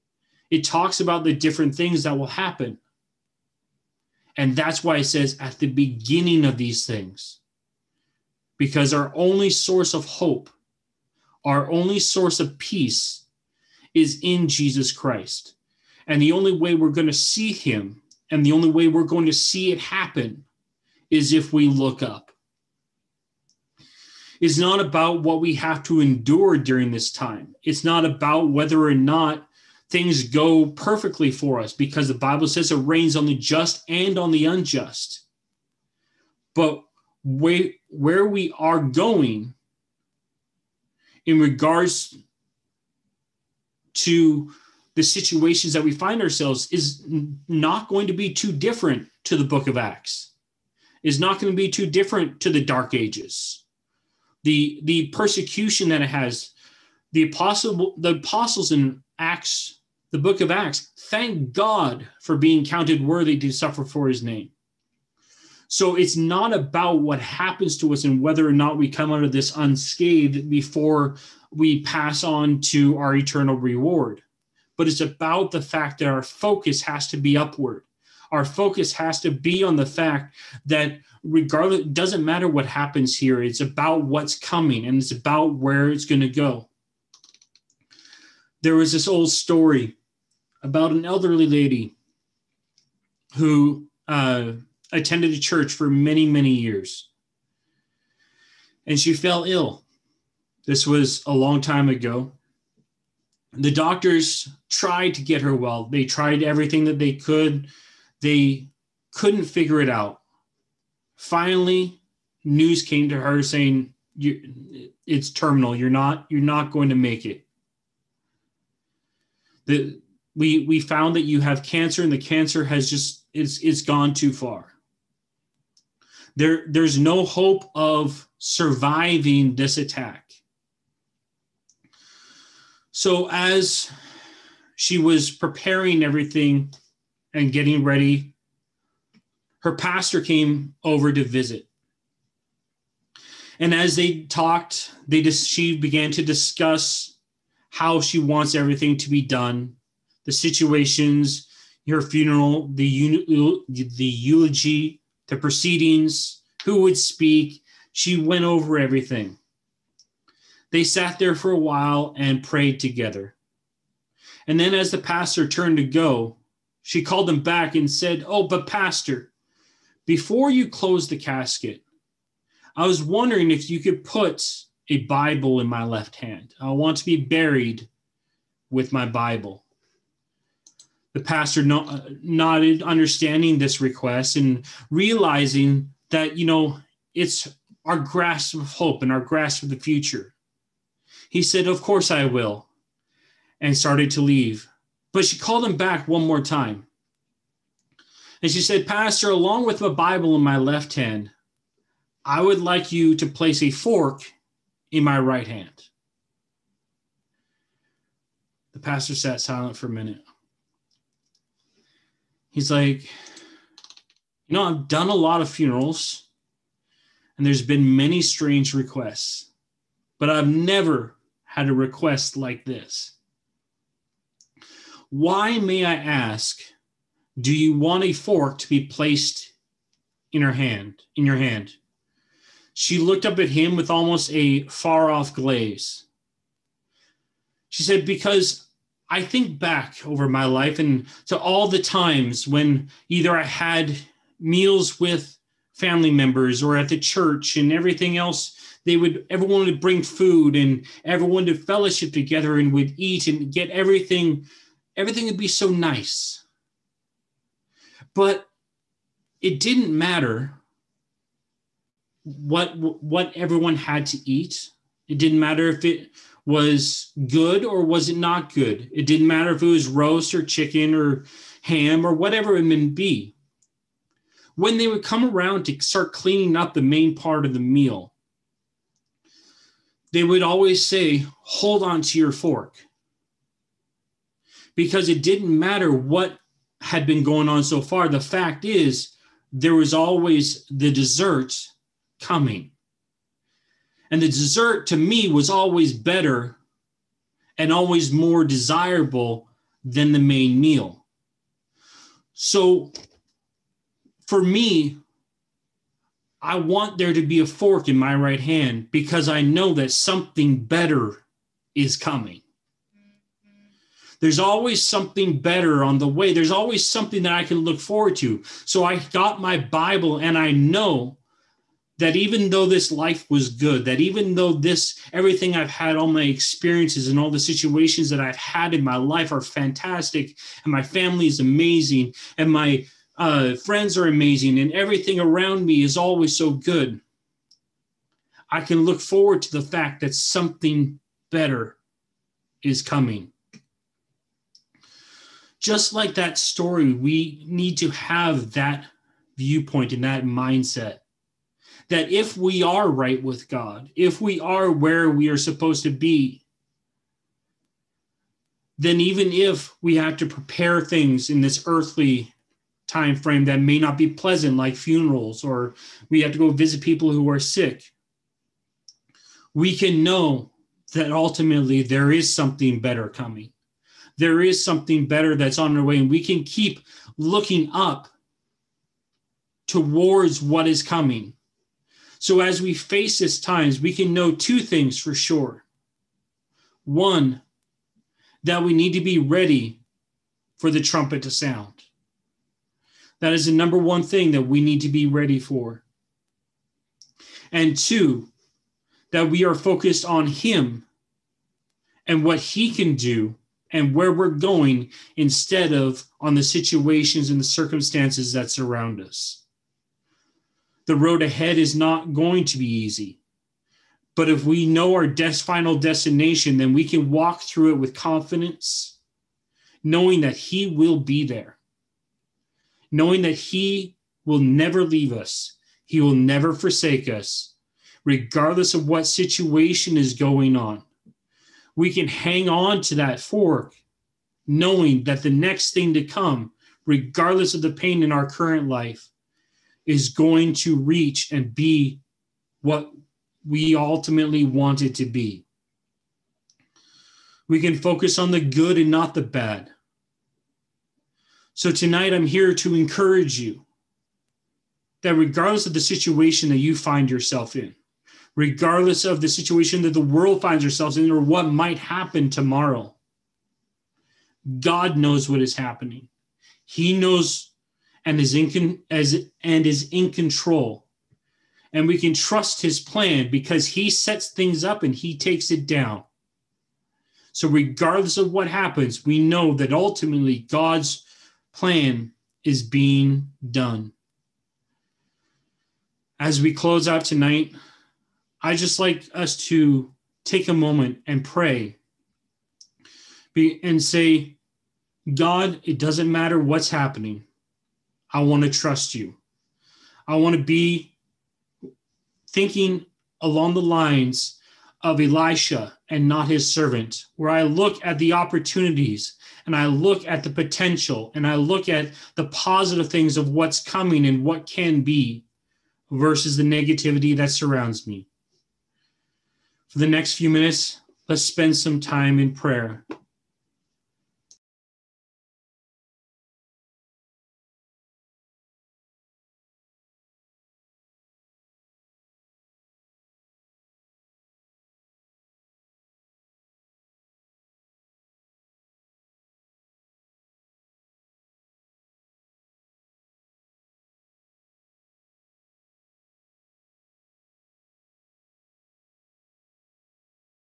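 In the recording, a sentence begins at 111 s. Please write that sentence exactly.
Finally, news came to her saying, it's terminal.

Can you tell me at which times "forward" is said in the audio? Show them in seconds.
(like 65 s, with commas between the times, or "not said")
317 s, 339 s.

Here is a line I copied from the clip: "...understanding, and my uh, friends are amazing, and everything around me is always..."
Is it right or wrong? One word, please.
wrong.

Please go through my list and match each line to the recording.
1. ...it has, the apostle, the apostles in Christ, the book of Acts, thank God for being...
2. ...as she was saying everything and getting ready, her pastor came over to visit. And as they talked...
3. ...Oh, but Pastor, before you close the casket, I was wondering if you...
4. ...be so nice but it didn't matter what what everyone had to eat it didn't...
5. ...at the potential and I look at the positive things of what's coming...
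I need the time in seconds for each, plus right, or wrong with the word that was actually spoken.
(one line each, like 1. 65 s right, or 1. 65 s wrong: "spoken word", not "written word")
1. 56 s wrong: "Acts", not "Christ"
2. 133 s wrong: "preparing", not "saying"
3. 168 s right
4. 255 s right
5. 510 s right.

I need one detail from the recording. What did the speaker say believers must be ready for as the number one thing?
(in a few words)
the trumpet to sound.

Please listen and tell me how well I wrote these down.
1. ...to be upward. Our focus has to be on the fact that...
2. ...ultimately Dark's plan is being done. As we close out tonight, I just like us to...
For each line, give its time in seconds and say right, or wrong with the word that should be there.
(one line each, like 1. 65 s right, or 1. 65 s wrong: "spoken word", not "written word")
1. 77 s right
2. 479 s wrong: "God", not "Dark".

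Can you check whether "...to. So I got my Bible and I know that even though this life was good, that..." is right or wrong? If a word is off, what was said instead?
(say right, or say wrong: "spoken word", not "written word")
right.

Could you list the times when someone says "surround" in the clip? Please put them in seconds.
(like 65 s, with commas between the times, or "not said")
408 s, 517 s.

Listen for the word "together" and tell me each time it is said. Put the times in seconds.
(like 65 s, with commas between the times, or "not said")
162 s, 252 s.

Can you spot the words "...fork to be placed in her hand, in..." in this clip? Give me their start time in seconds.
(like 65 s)
228 s.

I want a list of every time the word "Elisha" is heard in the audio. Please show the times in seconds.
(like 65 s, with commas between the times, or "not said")
505 s.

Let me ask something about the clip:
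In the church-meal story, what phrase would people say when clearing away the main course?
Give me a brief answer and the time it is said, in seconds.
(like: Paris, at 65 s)
hold on to your fork, at 281 s.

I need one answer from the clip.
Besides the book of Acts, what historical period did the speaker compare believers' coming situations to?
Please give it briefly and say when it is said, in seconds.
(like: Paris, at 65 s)
Dark Ages, at 52 s.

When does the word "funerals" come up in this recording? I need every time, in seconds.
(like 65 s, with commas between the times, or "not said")
152 s, 215 s, 364 s.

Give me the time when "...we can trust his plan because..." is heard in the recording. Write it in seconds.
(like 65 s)
471 s.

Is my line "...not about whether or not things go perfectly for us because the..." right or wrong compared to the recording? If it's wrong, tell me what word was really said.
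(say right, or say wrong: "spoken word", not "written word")
right.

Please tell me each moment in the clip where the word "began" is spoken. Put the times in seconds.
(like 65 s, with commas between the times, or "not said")
145 s.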